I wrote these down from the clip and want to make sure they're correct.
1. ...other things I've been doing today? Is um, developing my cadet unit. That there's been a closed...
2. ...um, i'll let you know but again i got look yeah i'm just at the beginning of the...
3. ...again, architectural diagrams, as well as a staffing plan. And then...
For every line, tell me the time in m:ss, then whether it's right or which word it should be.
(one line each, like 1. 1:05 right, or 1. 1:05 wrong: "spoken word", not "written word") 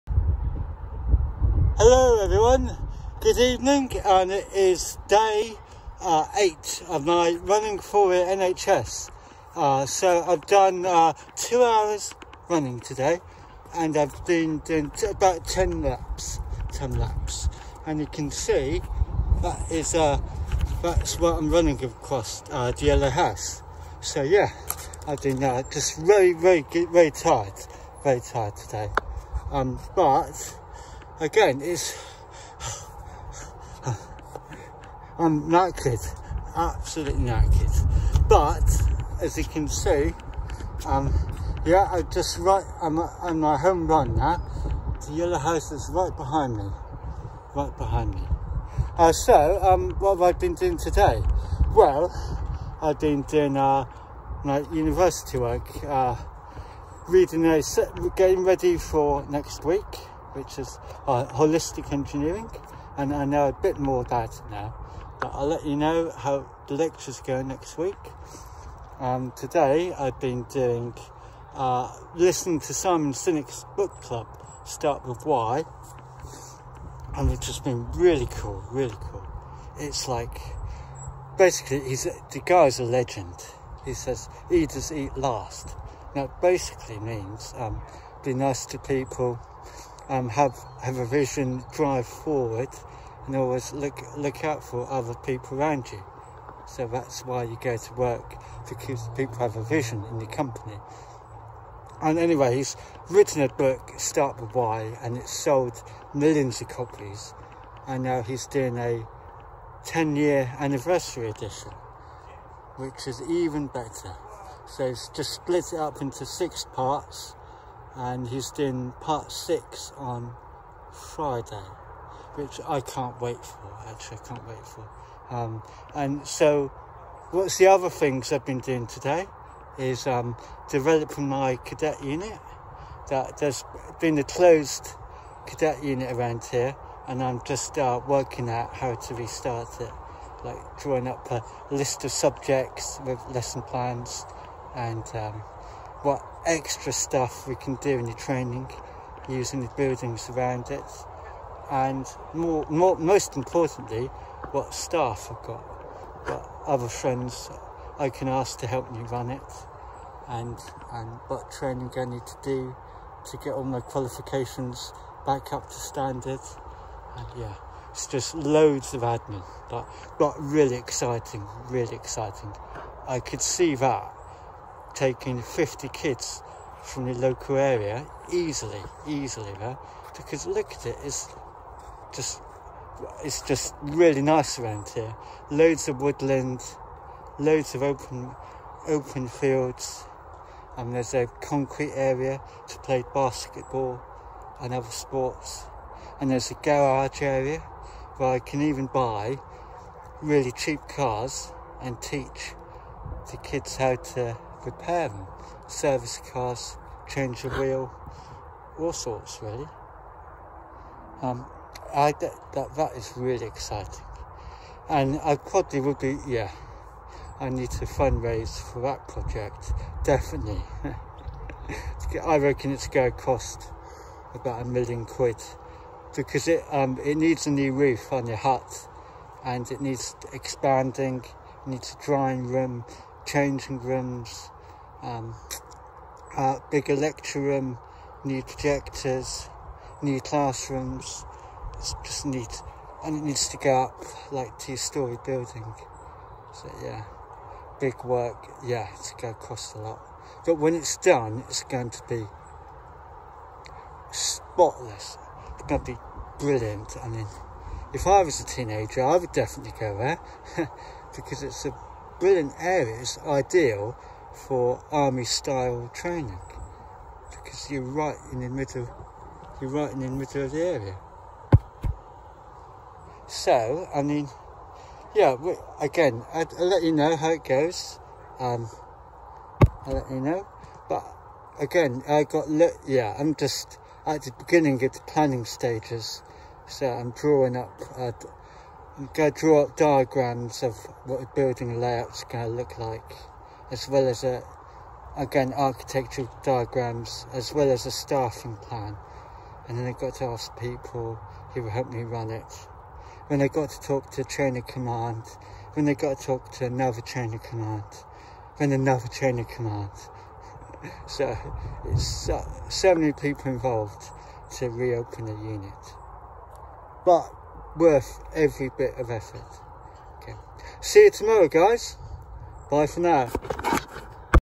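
1. 2:07 right
2. 4:38 right
3. 4:55 right.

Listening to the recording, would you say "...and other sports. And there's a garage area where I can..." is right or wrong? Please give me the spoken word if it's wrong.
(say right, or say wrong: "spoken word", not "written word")
right.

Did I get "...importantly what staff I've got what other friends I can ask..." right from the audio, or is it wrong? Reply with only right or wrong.
right.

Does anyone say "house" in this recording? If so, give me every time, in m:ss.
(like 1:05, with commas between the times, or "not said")
0:23, 0:45.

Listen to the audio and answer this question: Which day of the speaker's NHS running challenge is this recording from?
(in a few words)
Day 8.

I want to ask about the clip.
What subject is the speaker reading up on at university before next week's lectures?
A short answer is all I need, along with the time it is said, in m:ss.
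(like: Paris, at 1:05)
Holistic engineering, at 1:01.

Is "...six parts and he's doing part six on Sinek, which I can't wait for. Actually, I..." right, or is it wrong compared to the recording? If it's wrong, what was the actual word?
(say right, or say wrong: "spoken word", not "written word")
wrong: "Friday", not "Sinek".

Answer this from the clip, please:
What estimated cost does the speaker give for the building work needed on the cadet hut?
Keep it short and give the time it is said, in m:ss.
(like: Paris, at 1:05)
£1 million, at 3:44.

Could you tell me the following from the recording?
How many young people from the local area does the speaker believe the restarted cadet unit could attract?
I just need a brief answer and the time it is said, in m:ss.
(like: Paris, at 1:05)
50, at 2:55.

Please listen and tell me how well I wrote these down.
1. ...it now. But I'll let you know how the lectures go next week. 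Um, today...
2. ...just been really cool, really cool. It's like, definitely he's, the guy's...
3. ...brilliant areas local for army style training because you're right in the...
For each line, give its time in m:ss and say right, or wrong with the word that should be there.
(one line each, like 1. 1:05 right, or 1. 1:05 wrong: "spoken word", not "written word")
1. 1:04 right
2. 1:17 wrong: "basically", not "definitely"
3. 4:22 wrong: "ideal", not "local".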